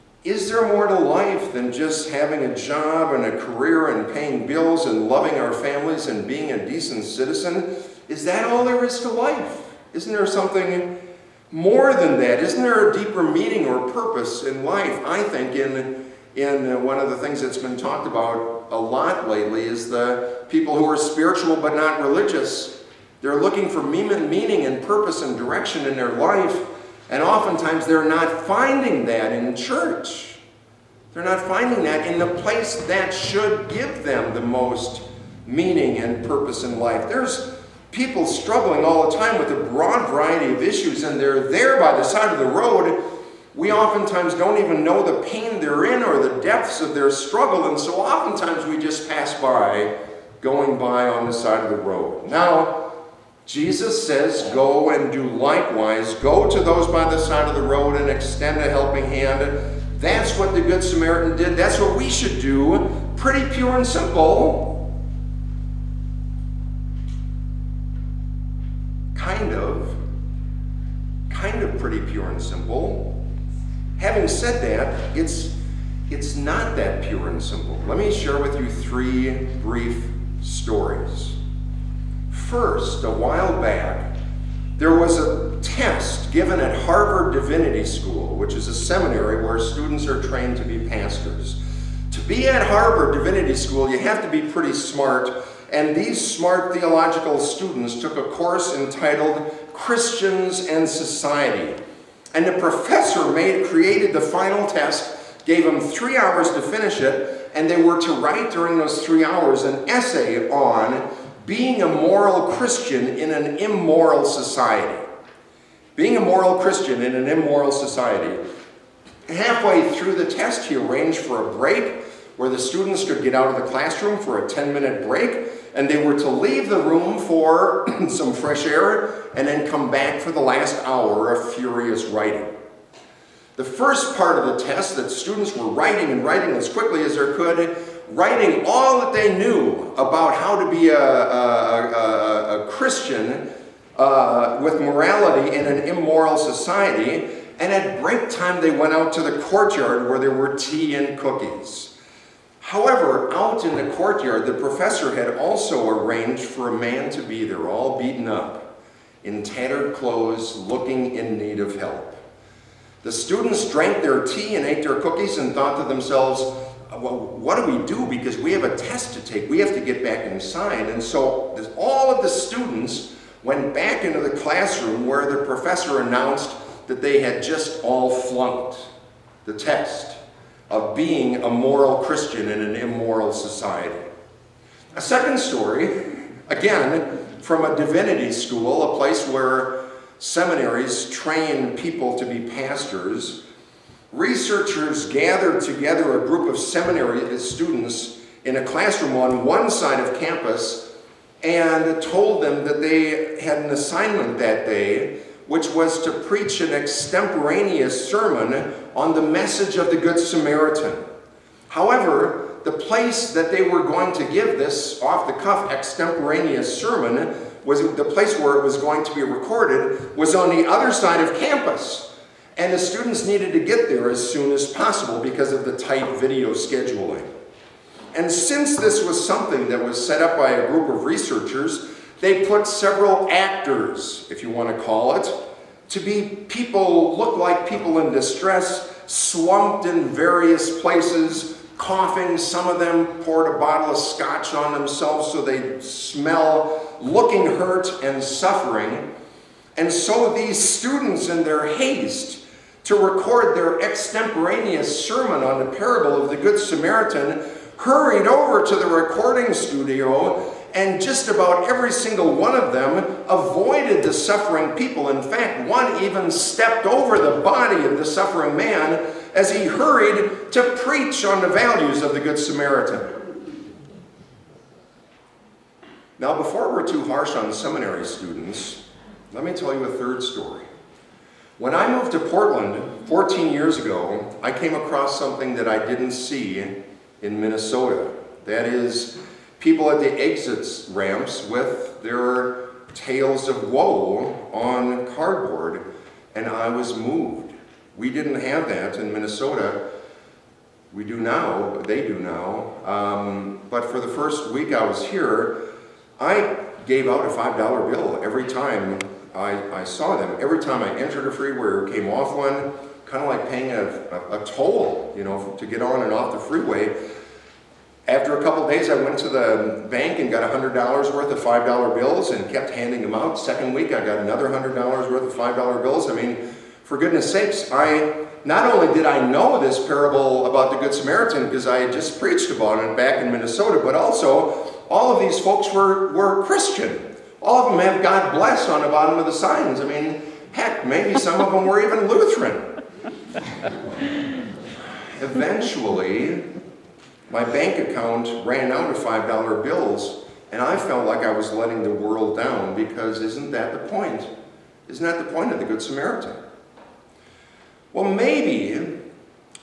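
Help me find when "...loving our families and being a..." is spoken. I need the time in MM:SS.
00:05.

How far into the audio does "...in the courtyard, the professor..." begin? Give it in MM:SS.
02:33.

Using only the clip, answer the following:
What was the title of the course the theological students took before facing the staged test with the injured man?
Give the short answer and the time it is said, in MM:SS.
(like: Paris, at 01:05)
Christians and Society, at 01:39.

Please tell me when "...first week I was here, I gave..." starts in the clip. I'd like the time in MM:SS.
05:04.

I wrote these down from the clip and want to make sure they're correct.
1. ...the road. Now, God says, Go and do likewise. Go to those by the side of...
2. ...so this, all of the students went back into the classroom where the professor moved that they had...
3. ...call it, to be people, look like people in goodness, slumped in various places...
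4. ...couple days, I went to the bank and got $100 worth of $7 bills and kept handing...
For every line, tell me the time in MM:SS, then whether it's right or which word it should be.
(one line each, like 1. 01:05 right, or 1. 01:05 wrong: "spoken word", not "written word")
1. 00:51 wrong: "Jesus", not "God"
2. 02:51 wrong: "announced", not "moved"
3. 03:54 wrong: "distress", not "goodness"
4. 05:18 wrong: "5", not "7".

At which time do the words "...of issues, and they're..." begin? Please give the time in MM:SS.
00:40.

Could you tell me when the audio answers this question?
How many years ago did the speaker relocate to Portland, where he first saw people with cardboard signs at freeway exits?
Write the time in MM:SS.
04:43.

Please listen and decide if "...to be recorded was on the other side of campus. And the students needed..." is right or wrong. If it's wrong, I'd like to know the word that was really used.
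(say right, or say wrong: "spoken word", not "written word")
right.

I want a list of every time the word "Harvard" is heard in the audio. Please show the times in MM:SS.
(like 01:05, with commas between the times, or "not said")
01:26, 01:32.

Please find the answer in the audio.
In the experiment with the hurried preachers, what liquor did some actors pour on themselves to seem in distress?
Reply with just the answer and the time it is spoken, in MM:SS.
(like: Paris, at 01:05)
Scotch, at 04:03.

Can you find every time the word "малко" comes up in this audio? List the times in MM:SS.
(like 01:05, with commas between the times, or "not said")
not said.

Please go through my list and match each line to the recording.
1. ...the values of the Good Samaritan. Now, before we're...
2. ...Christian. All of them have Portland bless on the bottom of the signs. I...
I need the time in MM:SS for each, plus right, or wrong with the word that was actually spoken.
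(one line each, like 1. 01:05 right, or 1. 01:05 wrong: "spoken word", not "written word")
1. 04:31 right
2. 05:36 wrong: "God", not "Portland".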